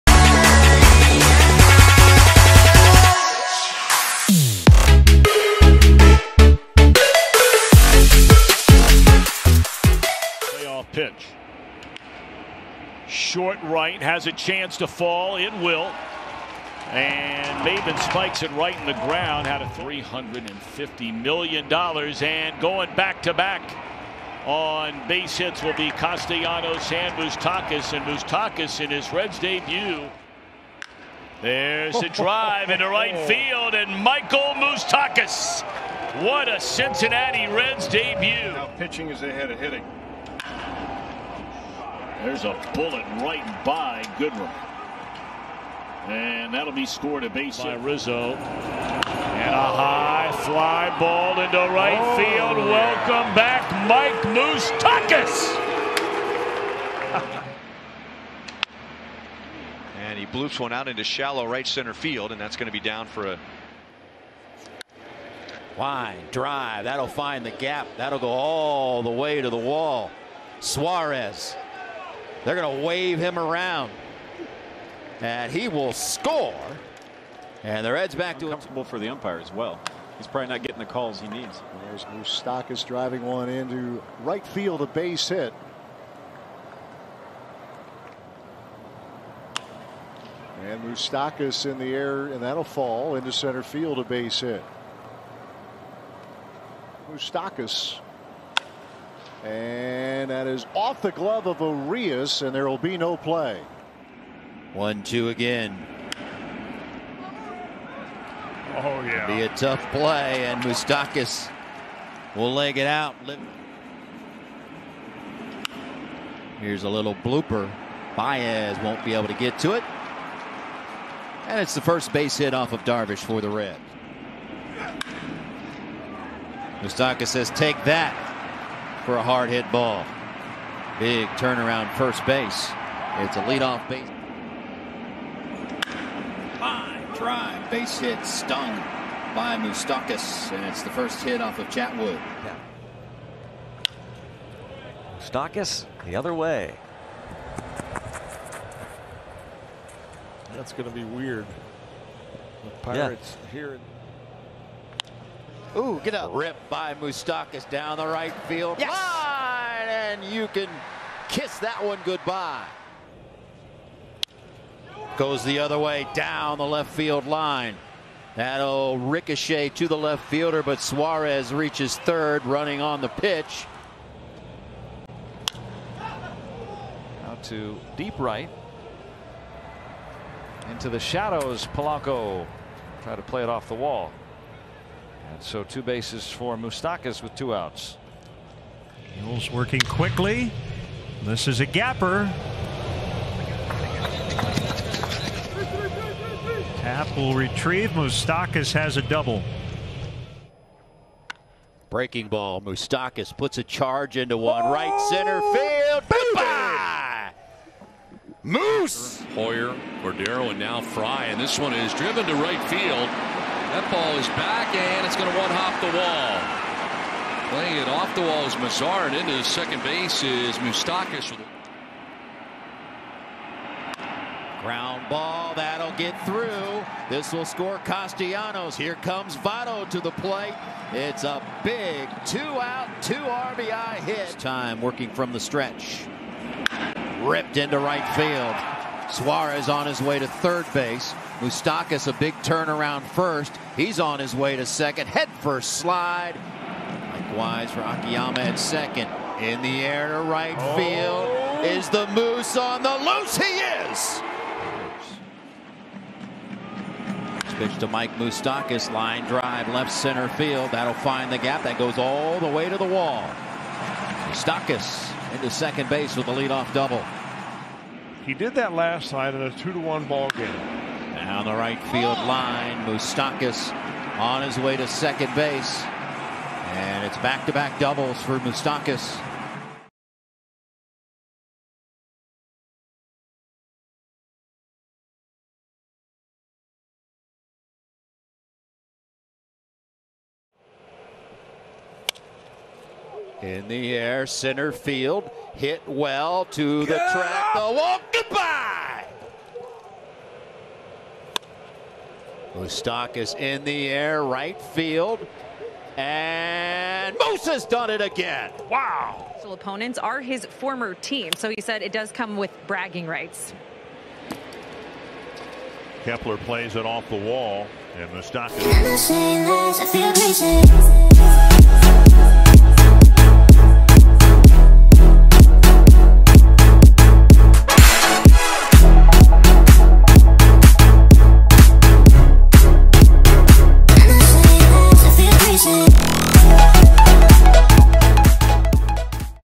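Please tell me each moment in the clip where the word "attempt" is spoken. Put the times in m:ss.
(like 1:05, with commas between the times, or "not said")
not said.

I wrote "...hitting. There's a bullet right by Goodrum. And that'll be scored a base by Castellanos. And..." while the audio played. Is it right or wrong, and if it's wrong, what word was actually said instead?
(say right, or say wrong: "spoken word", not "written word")
wrong: "Rizzo", not "Castellanos".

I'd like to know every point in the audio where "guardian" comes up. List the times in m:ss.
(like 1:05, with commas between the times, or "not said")
not said.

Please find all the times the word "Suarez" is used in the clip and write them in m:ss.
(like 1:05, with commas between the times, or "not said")
1:10, 2:50, 3:59.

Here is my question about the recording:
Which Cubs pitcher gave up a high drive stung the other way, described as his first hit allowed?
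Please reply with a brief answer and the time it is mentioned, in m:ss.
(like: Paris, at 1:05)
Chatwood, at 2:21.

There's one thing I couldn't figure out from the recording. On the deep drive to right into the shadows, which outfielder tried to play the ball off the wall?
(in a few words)
Polanco.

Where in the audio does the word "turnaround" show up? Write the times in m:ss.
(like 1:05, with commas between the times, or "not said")
2:11, 4:02.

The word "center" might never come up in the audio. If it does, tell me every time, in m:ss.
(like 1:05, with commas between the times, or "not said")
1:01, 1:33, 3:25, 4:19, 4:54.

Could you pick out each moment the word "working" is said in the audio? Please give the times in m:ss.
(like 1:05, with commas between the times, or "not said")
3:09, 3:54.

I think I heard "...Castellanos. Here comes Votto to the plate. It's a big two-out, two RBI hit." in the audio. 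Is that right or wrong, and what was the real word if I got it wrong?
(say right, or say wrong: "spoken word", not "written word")
right.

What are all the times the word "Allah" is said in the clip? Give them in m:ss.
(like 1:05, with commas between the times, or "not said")
not said.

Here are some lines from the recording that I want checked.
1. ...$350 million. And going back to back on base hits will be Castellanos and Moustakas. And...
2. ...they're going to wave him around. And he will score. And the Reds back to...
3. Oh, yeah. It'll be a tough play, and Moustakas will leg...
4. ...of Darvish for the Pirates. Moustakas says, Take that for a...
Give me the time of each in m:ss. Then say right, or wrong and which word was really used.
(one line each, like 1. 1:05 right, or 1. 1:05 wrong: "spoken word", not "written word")
1. 0:19 right
2. 1:12 right
3. 1:48 right
4. 2:02 wrong: "Reds", not "Pirates".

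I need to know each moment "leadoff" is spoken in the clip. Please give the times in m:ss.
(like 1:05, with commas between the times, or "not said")
2:13, 4:26.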